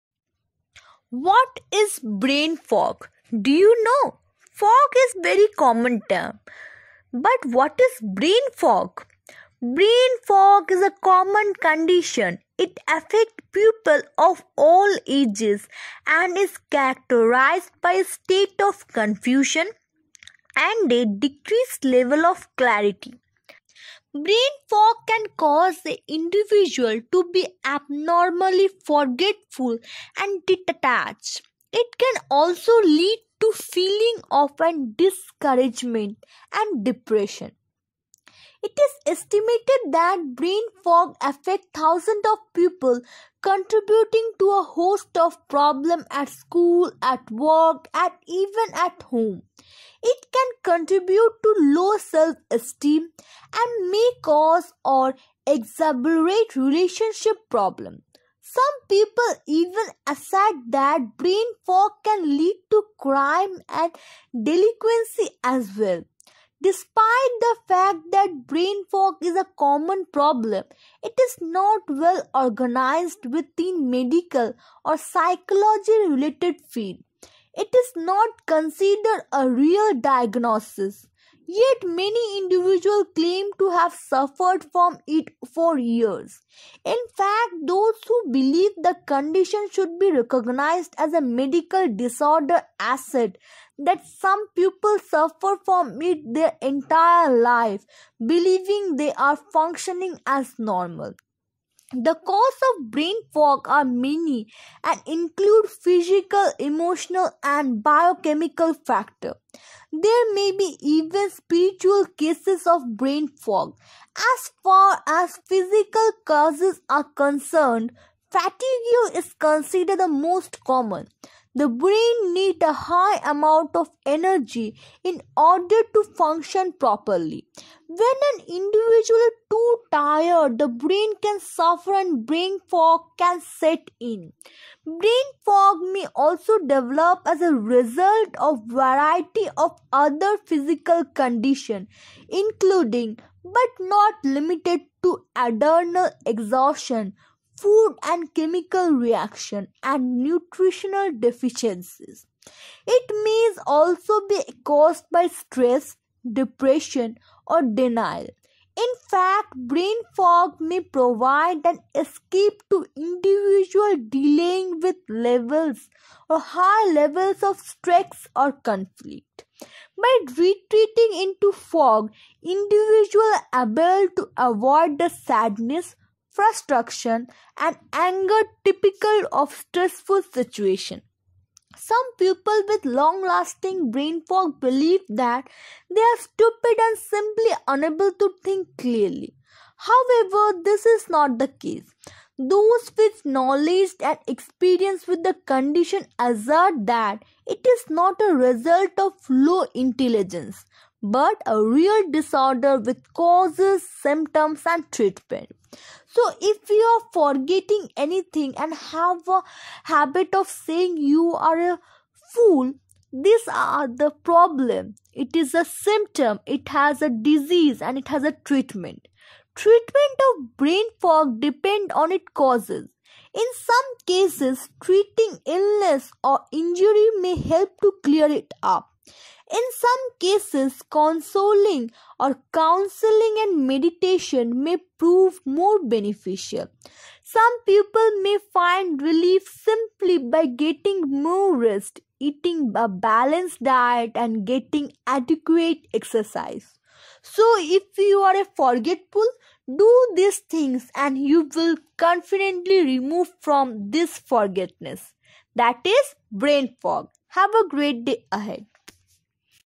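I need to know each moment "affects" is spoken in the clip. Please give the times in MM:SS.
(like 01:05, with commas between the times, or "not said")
00:12, 00:41.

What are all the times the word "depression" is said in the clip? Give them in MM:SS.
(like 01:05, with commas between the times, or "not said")
00:36, 02:36.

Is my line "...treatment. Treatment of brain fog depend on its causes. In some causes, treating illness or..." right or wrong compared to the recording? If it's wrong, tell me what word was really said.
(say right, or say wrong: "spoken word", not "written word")
wrong: "cases", not "causes".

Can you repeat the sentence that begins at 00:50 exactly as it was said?
It can contribute to low self esteem and may cause or exacerbate relationship problems.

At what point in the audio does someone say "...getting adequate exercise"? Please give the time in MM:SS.
04:04.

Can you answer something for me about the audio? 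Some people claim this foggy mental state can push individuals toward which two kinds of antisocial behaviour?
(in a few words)
Crime and delinquency.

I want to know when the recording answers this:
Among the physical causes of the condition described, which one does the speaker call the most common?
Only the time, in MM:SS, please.
01:58.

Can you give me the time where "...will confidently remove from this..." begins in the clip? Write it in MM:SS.
04:11.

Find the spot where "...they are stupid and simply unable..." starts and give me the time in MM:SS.
03:05.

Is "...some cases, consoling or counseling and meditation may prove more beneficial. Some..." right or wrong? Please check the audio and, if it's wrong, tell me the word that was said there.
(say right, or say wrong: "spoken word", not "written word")
right.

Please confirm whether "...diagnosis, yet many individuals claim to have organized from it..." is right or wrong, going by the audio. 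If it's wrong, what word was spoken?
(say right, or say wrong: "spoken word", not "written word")
wrong: "suffered", not "organized".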